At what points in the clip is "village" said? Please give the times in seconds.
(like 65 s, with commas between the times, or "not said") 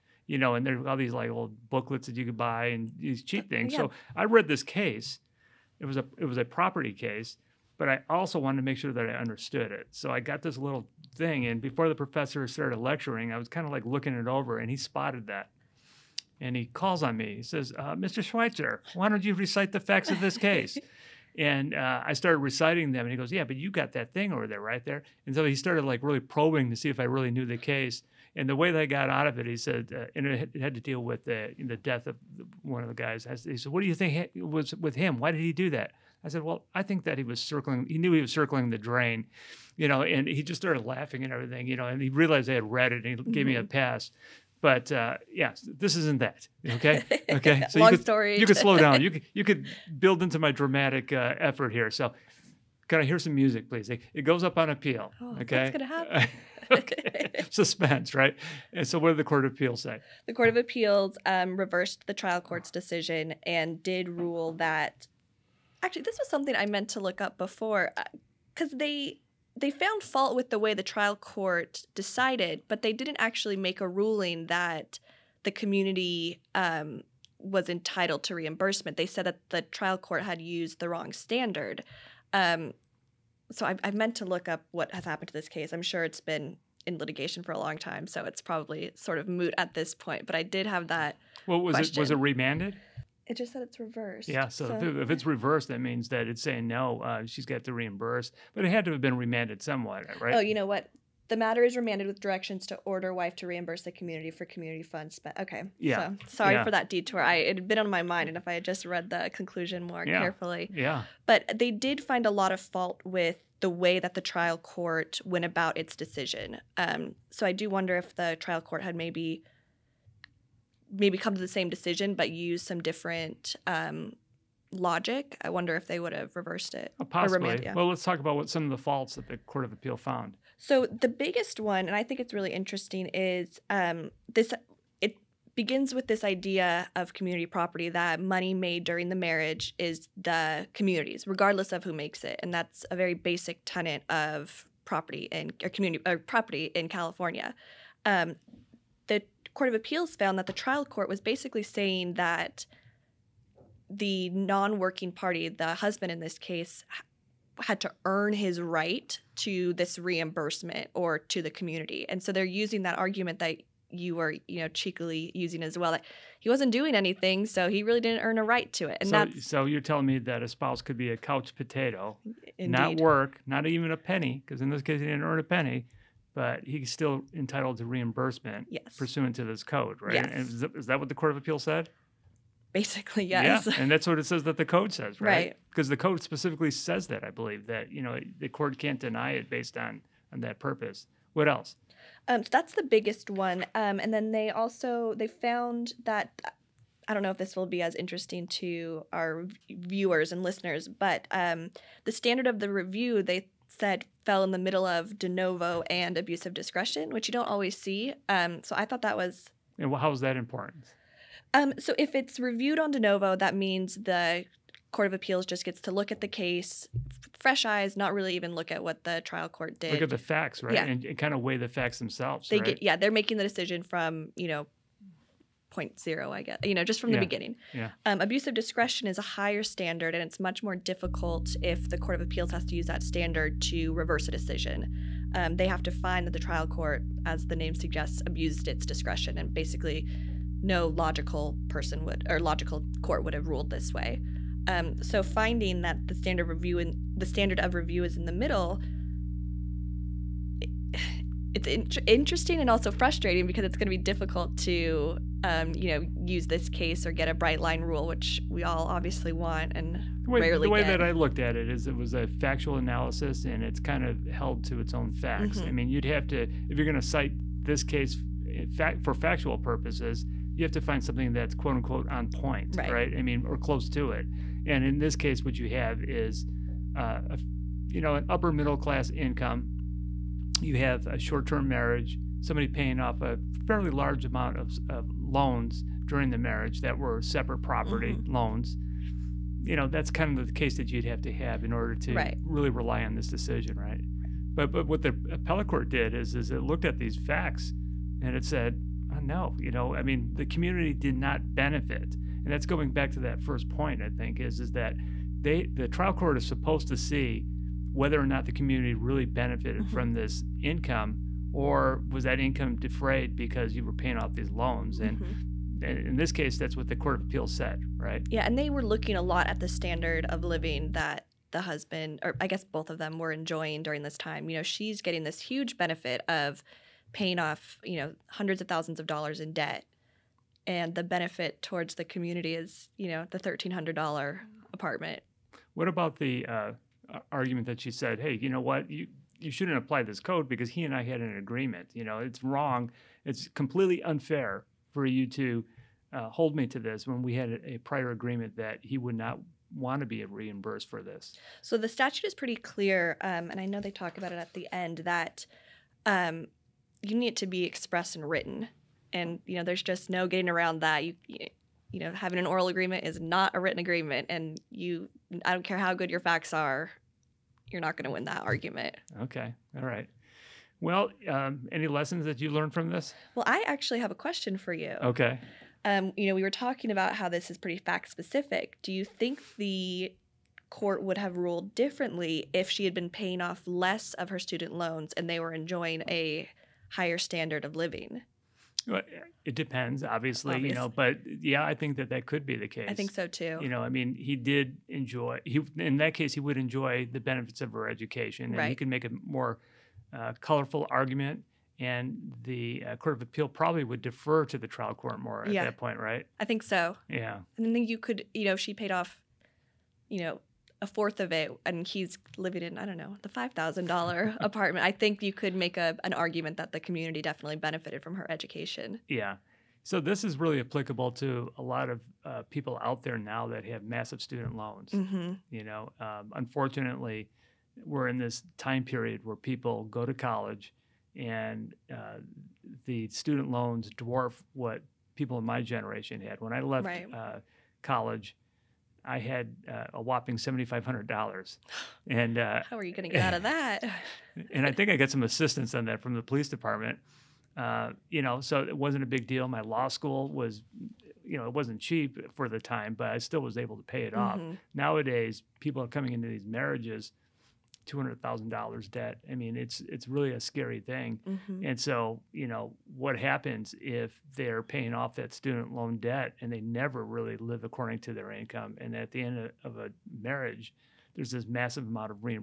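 not said.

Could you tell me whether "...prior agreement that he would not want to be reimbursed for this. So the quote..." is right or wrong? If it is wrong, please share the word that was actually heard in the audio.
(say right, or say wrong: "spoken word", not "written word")
wrong: "statute", not "quote".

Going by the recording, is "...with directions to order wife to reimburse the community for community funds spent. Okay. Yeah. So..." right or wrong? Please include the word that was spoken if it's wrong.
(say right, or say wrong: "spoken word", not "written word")
right.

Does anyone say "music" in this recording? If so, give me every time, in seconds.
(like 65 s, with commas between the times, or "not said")
53 s.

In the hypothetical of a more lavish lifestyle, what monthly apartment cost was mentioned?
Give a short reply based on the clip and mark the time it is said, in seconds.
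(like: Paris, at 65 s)
$5000, at 413 s.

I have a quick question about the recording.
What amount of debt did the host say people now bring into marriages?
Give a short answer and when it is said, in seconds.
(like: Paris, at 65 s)
$200,000, at 457 s.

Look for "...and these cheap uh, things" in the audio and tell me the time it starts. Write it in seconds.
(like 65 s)
2 s.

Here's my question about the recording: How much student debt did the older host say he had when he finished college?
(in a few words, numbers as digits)
$7,500.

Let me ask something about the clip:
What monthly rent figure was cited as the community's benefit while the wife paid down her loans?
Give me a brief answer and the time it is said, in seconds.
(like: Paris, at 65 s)
$1,300, at 333 s.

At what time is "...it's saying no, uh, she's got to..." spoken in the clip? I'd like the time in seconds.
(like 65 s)
96 s.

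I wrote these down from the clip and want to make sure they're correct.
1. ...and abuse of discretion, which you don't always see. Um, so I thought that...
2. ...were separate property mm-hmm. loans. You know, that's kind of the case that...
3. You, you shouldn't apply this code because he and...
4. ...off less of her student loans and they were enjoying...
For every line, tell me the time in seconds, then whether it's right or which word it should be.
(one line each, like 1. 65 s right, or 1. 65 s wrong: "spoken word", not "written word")
1. 205 s right
2. 286 s right
3. 338 s right
4. 383 s right.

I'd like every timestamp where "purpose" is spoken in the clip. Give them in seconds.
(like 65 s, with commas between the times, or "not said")
190 s, 269 s.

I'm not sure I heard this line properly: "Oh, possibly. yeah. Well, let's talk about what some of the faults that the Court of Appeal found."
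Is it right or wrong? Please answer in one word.
right.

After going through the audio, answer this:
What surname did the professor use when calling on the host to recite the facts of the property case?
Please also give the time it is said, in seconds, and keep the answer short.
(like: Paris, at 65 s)
Schweitzer, at 18 s.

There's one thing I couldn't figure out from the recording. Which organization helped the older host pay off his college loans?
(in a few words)
the police department.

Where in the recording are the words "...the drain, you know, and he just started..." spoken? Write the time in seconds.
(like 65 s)
38 s.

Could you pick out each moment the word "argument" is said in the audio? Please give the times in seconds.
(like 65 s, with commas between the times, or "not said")
162 s, 337 s, 368 s, 400 s, 416 s.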